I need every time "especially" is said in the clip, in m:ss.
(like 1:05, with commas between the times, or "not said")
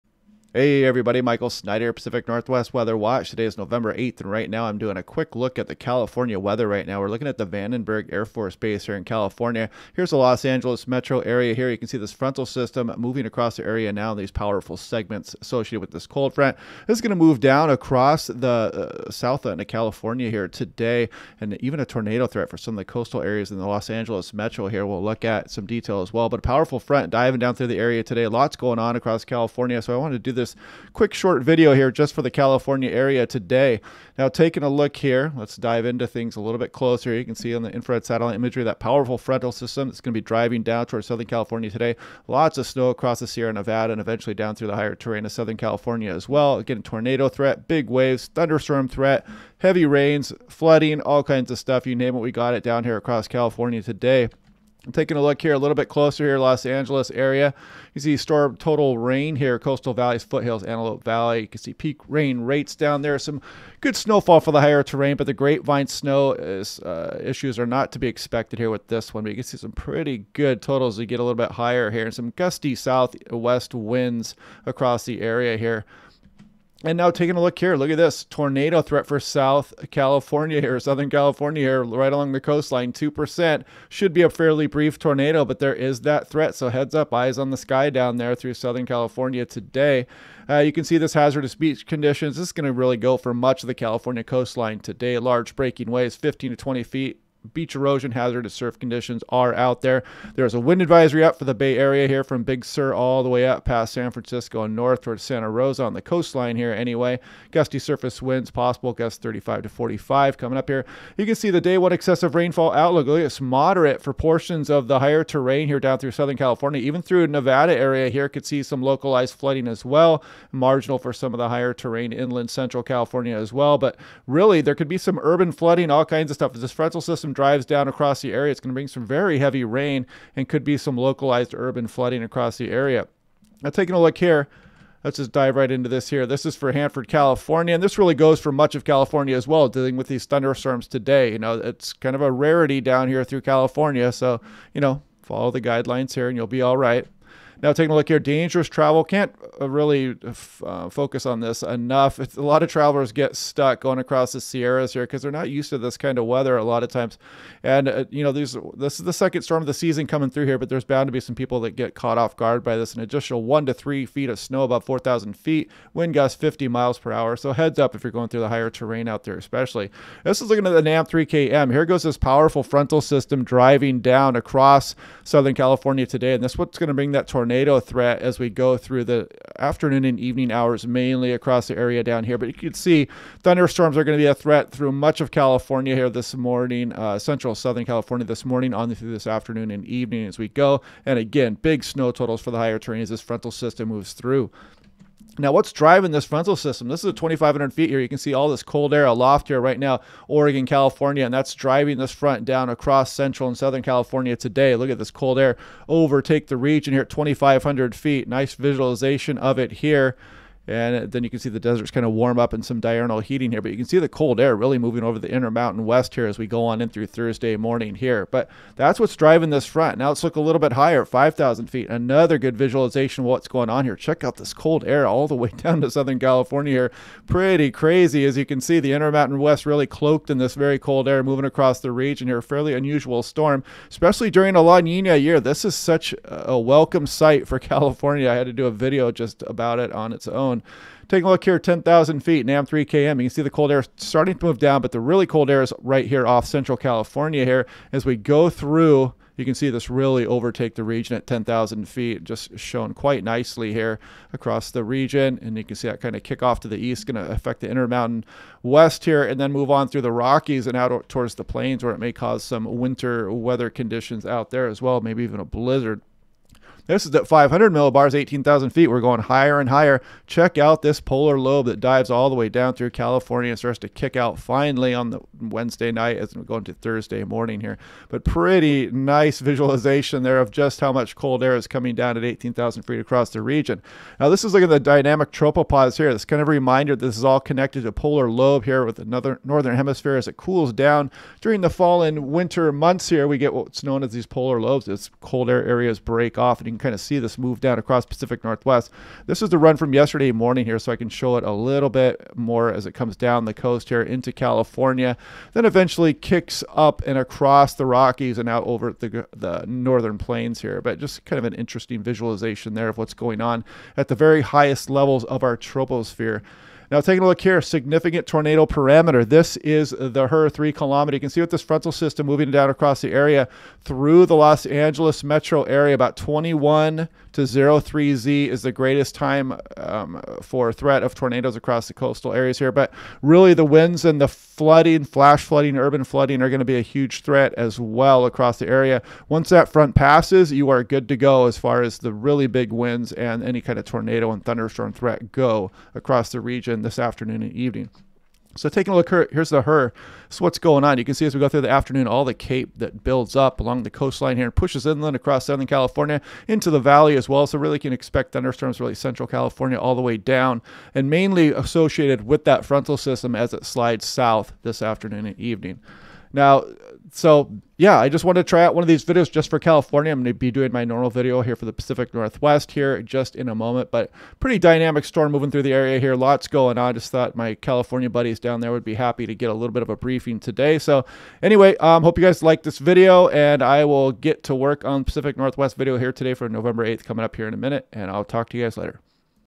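2:49, 3:53.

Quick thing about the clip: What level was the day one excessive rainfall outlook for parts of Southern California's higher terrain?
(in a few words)
Moderate.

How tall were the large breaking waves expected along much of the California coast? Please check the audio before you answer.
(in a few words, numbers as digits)
15 to 20 feet.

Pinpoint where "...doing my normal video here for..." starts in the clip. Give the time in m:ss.
6:10.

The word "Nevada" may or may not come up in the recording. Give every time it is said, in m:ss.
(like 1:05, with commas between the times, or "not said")
0:43, 1:57.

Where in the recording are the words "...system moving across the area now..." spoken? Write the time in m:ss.
0:12.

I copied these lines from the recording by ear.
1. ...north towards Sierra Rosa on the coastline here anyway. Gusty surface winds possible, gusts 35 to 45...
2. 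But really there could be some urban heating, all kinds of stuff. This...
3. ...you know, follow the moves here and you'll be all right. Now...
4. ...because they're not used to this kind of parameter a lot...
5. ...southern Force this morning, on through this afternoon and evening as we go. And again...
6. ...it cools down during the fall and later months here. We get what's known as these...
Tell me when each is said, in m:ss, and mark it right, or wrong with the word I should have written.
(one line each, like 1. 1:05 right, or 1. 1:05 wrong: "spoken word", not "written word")
1. 1:44 wrong: "Santa", not "Sierra"
2. 2:03 wrong: "flooding", not "heating"
3. 2:24 wrong: "guidelines", not "moves"
4. 2:35 wrong: "weather", not "parameter"
5. 3:07 wrong: "California", not "Force"
6. 4:50 wrong: "winter", not "later".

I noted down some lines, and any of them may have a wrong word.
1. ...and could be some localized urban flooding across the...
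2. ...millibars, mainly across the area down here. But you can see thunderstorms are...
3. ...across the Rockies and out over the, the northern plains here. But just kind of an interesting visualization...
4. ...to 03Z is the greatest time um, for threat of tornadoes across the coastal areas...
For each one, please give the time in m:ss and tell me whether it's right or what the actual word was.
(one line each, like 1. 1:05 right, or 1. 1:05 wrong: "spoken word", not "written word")
1. 2:10 right
2. 3:00 wrong: "hours", not "millibars"
3. 5:07 right
4. 5:27 right.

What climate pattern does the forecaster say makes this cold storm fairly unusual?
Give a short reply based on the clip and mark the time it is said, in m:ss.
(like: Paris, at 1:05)
La Nina, at 3:54.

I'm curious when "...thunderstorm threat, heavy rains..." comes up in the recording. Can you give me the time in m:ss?
0:48.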